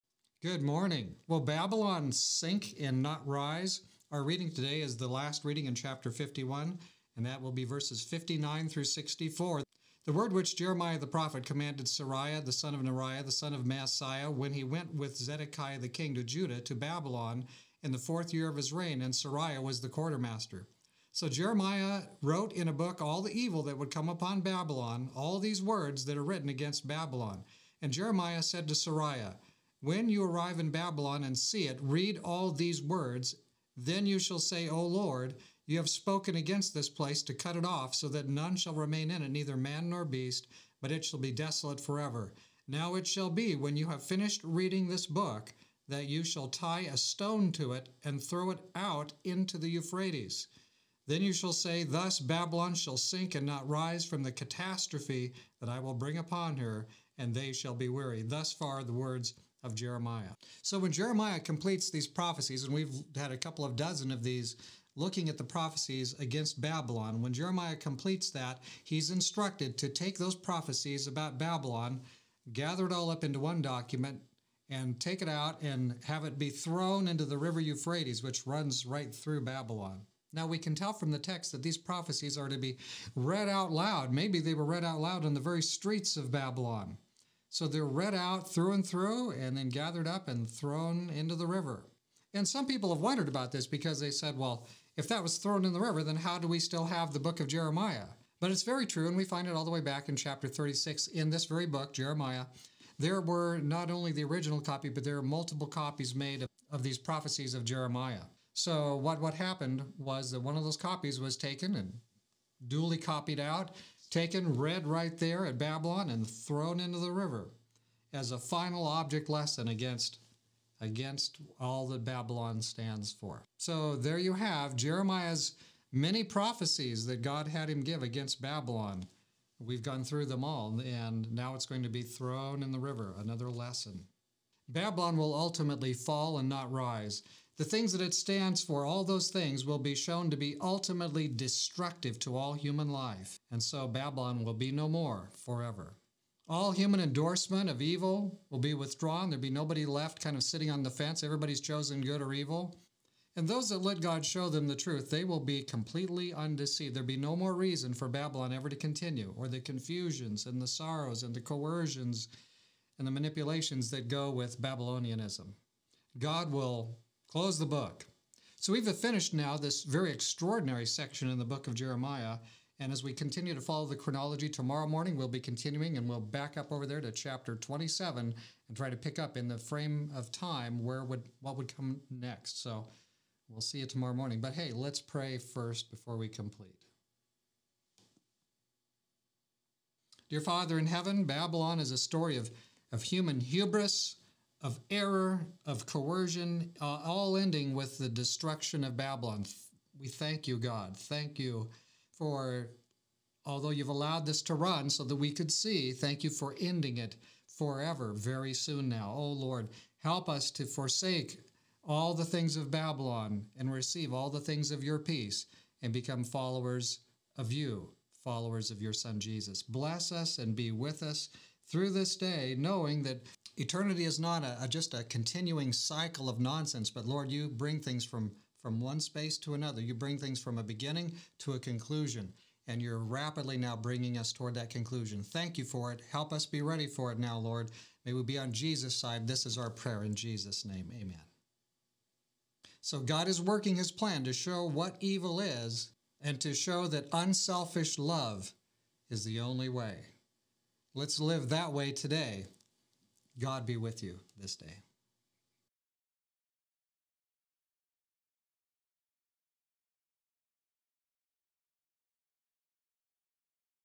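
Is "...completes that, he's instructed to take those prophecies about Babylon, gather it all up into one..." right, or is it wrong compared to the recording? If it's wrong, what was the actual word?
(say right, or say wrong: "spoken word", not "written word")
right.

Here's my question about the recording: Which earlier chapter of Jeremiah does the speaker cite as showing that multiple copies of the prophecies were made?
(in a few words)
chapter 36.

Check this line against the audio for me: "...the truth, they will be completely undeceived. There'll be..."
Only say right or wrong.
right.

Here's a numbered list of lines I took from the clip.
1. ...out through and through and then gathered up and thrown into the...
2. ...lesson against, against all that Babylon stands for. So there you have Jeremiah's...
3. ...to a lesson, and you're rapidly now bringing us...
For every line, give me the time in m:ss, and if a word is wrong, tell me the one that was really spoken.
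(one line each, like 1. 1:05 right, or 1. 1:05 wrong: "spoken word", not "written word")
1. 1:28 right
2. 1:59 right
3. 3:51 wrong: "conclusion", not "lesson".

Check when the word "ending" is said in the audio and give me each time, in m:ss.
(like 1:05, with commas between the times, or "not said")
3:17, 3:26.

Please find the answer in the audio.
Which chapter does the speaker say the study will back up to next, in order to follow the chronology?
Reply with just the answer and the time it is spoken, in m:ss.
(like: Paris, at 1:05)
chapter 27, at 2:57.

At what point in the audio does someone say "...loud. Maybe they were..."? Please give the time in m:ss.
1:23.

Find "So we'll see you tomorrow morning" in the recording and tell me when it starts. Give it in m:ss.
3:02.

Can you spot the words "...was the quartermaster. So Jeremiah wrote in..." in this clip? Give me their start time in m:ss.
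0:19.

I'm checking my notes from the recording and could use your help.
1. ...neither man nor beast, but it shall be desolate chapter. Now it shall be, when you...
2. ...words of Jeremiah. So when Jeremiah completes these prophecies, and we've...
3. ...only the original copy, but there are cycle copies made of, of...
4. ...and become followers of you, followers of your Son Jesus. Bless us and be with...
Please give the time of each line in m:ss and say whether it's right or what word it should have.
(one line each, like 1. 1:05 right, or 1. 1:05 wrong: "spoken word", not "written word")
1. 0:39 wrong: "forever", not "chapter"
2. 0:58 right
3. 1:43 wrong: "multiple", not "cycle"
4. 3:35 right.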